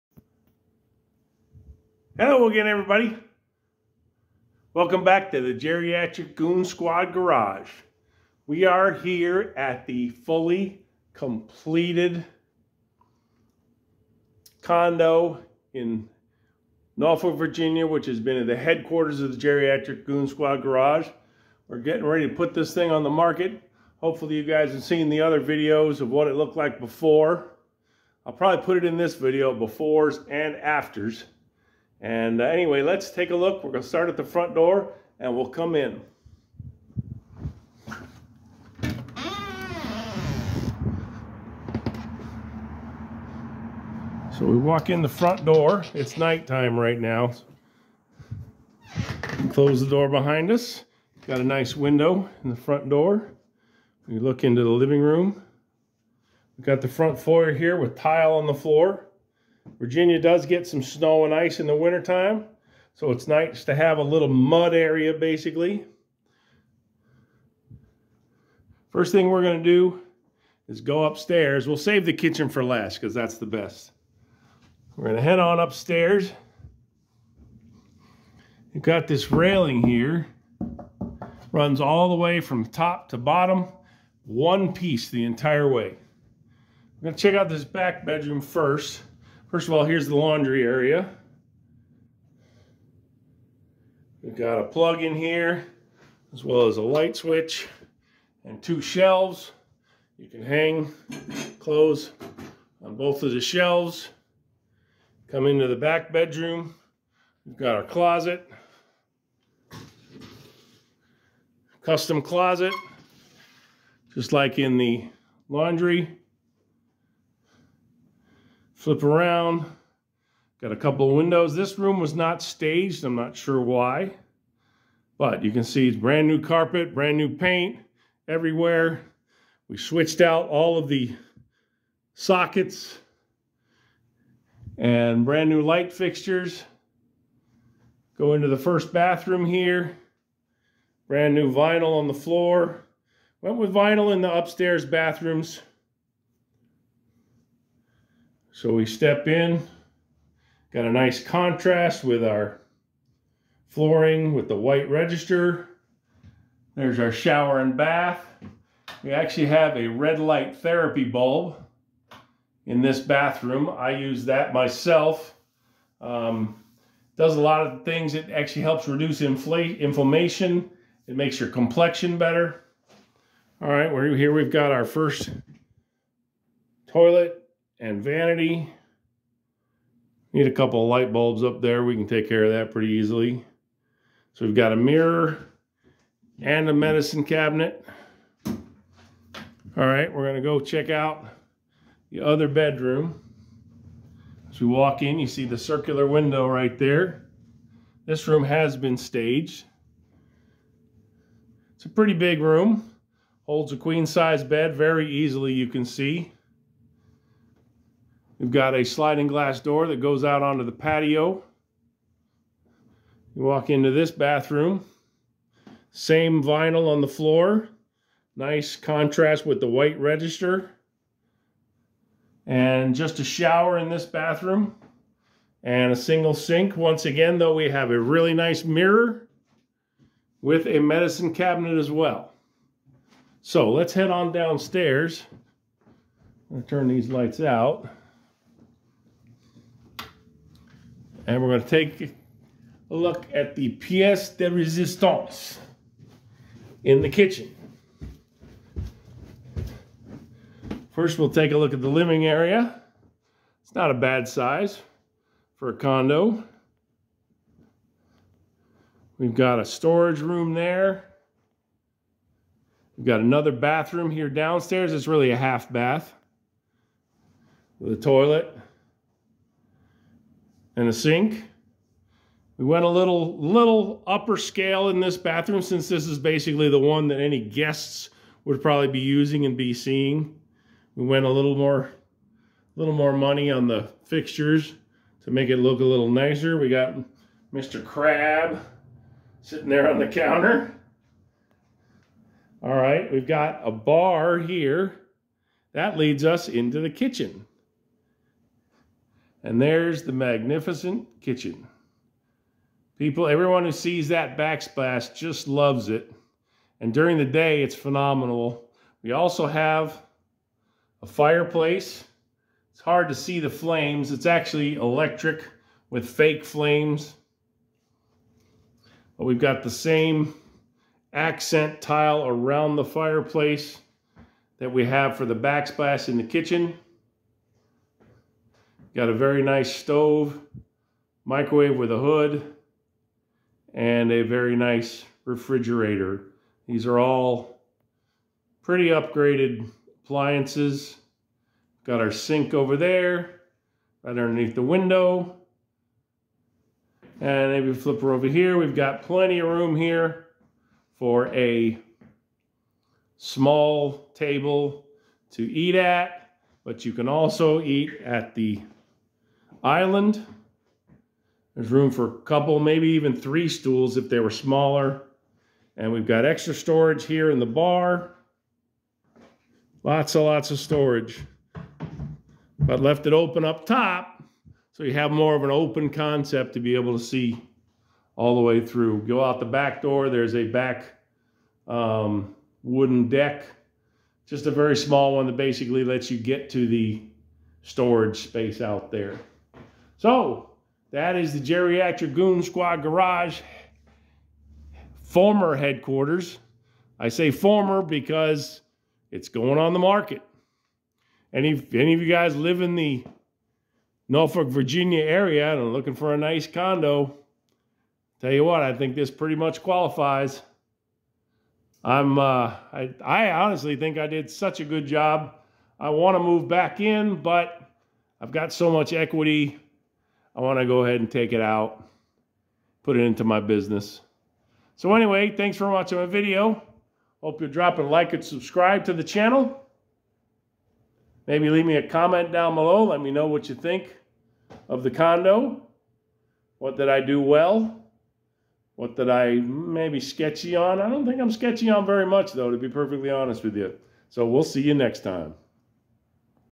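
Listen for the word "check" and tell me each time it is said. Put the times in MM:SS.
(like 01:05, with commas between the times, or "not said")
01:27, 03:10.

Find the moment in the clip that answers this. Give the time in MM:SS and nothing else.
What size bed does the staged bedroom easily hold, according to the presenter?
03:23.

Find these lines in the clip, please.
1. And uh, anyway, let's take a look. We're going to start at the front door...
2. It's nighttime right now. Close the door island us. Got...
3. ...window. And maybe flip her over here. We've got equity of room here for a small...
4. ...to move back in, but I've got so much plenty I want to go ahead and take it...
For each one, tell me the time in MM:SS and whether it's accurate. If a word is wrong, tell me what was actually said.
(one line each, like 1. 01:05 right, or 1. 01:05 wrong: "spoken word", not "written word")
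1. 00:32 right
2. 00:45 wrong: "behind", not "island"
3. 05:44 wrong: "plenty", not "equity"
4. 06:56 wrong: "equity", not "plenty".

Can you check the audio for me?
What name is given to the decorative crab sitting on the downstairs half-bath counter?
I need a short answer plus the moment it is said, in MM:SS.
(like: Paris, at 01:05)
Mr. Crab, at 04:47.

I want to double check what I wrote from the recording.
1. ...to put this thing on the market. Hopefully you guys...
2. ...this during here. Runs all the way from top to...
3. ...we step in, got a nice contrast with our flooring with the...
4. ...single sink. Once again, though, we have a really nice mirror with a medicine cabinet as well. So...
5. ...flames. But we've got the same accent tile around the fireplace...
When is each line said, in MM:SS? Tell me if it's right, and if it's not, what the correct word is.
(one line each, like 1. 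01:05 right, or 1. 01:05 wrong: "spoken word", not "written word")
1. 00:22 right
2. 01:19 wrong: "railing", not "during"
3. 02:28 right
4. 03:45 right
5. 05:16 right.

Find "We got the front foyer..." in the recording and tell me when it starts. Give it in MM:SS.
00:56.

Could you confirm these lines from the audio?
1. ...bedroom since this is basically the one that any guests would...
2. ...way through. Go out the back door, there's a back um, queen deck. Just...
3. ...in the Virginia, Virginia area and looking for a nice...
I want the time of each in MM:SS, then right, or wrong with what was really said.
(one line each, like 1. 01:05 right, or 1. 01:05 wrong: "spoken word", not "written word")
1. 04:35 wrong: "bathroom", not "bedroom"
2. 06:18 wrong: "wooden", not "queen"
3. 06:42 wrong: "Norfolk", not "Virginia".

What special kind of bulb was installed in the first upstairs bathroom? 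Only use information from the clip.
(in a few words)
Red light therapy bulb.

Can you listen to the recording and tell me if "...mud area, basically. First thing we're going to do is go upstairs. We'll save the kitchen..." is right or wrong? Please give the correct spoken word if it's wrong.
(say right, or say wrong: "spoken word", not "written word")
right.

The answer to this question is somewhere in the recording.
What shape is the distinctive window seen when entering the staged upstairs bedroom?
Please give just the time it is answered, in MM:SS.
03:15.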